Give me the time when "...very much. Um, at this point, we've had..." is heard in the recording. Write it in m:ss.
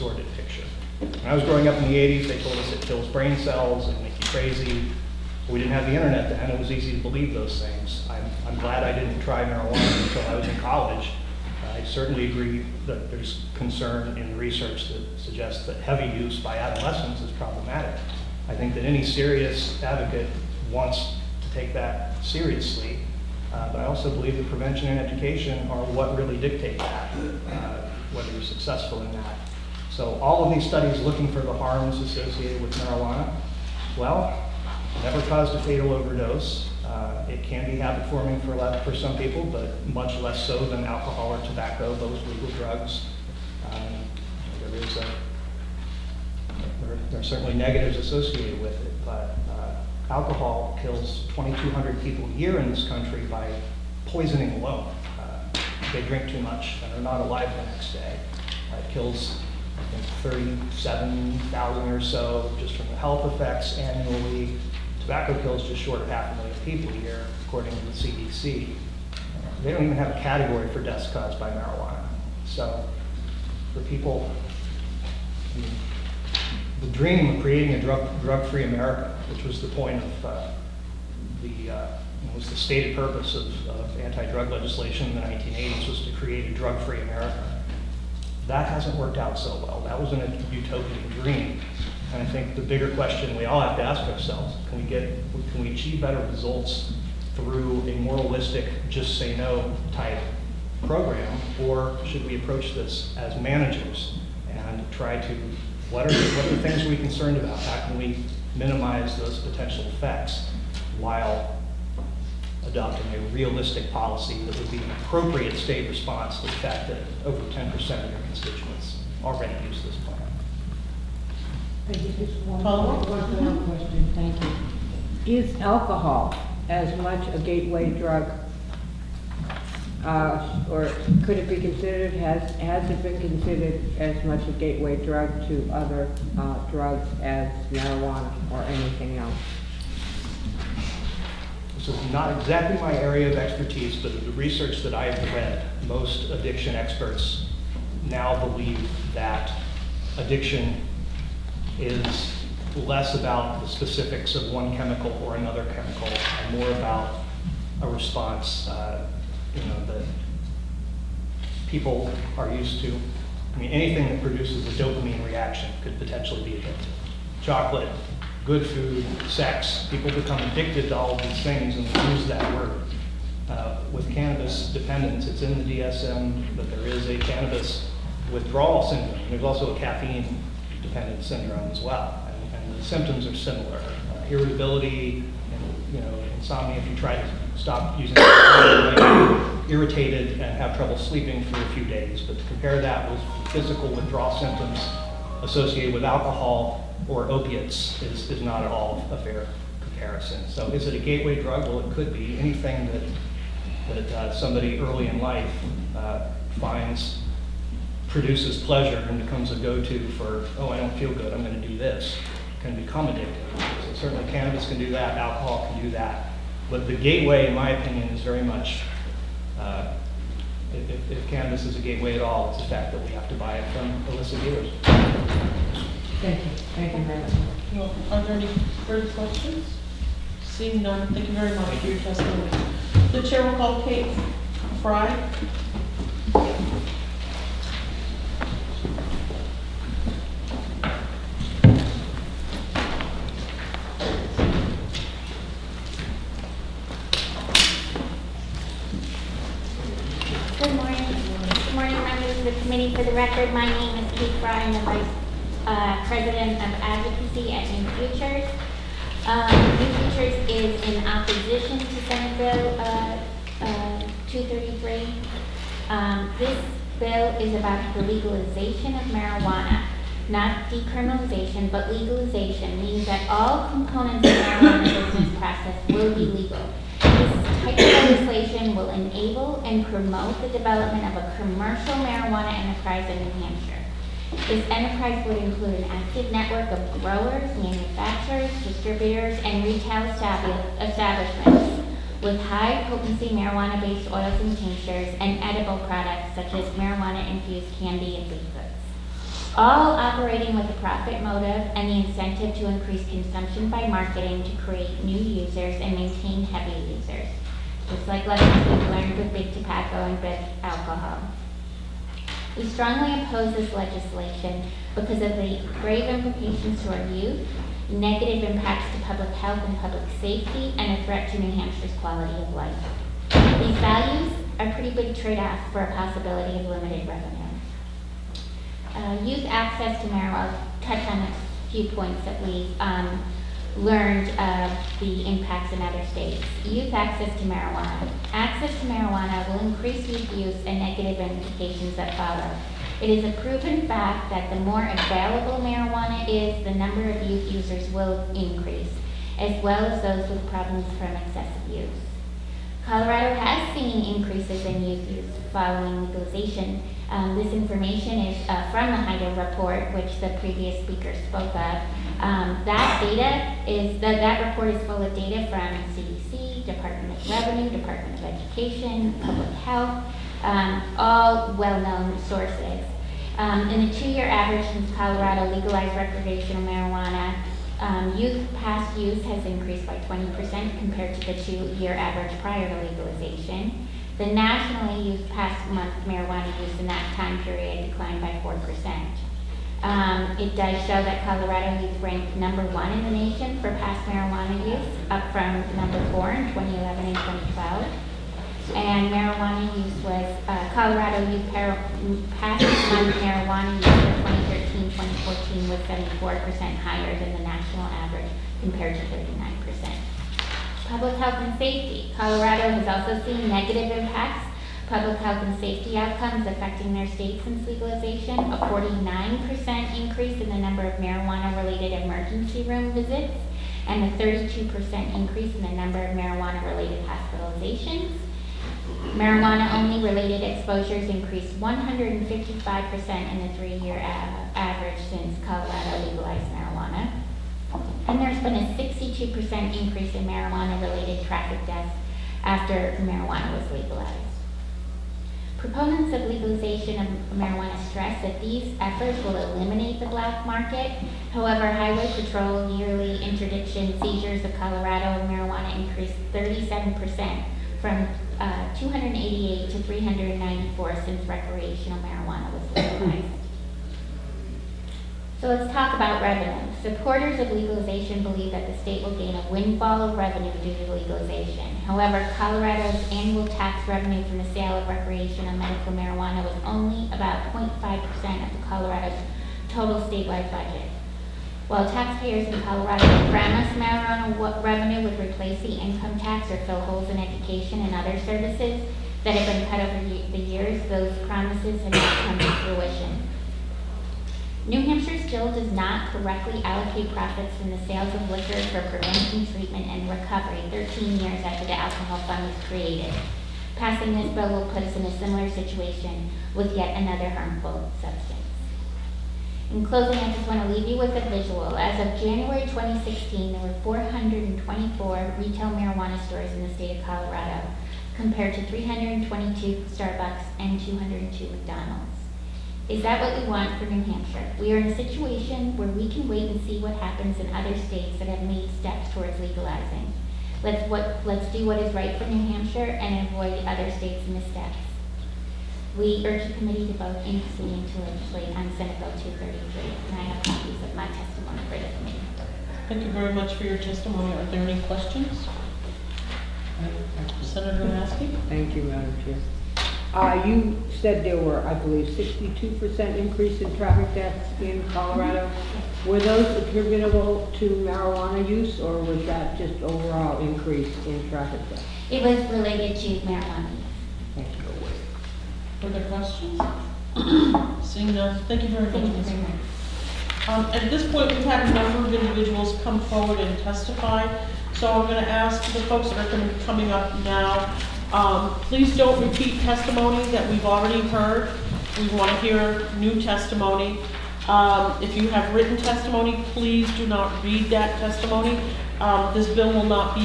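9:29.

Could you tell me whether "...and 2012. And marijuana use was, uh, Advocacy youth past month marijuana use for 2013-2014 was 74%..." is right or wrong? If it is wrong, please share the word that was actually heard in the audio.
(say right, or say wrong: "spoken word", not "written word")
wrong: "Colorado", not "Advocacy".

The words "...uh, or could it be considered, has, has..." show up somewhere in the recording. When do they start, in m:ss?
2:10.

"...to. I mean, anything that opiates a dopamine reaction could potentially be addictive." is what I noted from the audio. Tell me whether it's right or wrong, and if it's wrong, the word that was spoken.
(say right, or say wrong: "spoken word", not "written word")
wrong: "produces", not "opiates".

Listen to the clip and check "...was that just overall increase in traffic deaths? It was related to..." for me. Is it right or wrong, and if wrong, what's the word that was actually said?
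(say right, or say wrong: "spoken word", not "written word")
right.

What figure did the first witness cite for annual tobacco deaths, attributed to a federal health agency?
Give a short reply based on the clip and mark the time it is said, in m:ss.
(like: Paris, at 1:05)
just short of half a million, at 1:05.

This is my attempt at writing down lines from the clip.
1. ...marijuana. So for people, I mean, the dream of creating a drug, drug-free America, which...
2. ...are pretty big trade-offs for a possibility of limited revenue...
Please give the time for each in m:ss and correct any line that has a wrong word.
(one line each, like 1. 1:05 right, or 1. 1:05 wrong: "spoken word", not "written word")
1. 1:11 right
2. 5:24 right.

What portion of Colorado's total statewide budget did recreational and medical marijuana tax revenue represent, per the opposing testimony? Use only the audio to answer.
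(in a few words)
0.5%.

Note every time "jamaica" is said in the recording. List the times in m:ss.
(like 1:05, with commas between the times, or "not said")
not said.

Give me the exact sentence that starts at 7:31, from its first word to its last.
However, Highway Patrol yearly interdiction seizures of Colorado of marijuana increased 37% from uh, 288 to 394 since recreational marijuana was legalized.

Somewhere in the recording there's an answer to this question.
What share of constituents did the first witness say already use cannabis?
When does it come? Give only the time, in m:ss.
1:57.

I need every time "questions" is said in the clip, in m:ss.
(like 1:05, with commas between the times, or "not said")
1:32, 2:03, 3:49, 9:04, 9:26.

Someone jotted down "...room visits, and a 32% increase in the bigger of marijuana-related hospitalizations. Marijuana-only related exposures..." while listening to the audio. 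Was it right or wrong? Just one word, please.
wrong.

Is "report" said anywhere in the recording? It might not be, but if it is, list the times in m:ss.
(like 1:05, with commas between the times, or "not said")
5:59, 6:04.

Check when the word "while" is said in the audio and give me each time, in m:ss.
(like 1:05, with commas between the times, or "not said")
1:50, 8:01.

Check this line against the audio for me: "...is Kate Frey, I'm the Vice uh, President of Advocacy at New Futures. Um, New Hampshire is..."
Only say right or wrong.
wrong.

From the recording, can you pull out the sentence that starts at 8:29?
In closing, I just want to leave you with a visual.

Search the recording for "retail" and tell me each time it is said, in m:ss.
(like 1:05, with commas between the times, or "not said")
4:49, 8:35.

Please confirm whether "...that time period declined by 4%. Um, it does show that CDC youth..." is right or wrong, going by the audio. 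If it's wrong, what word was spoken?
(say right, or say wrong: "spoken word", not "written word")
wrong: "Colorado", not "CDC".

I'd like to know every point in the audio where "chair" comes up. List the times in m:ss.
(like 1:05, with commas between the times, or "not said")
3:53, 9:09.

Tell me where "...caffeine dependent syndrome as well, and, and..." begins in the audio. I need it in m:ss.
2:59.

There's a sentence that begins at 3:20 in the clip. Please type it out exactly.
So is it a gateway drug?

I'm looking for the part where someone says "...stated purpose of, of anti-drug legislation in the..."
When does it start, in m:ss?
1:22.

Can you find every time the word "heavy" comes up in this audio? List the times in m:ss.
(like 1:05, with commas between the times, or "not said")
0:15, 5:06.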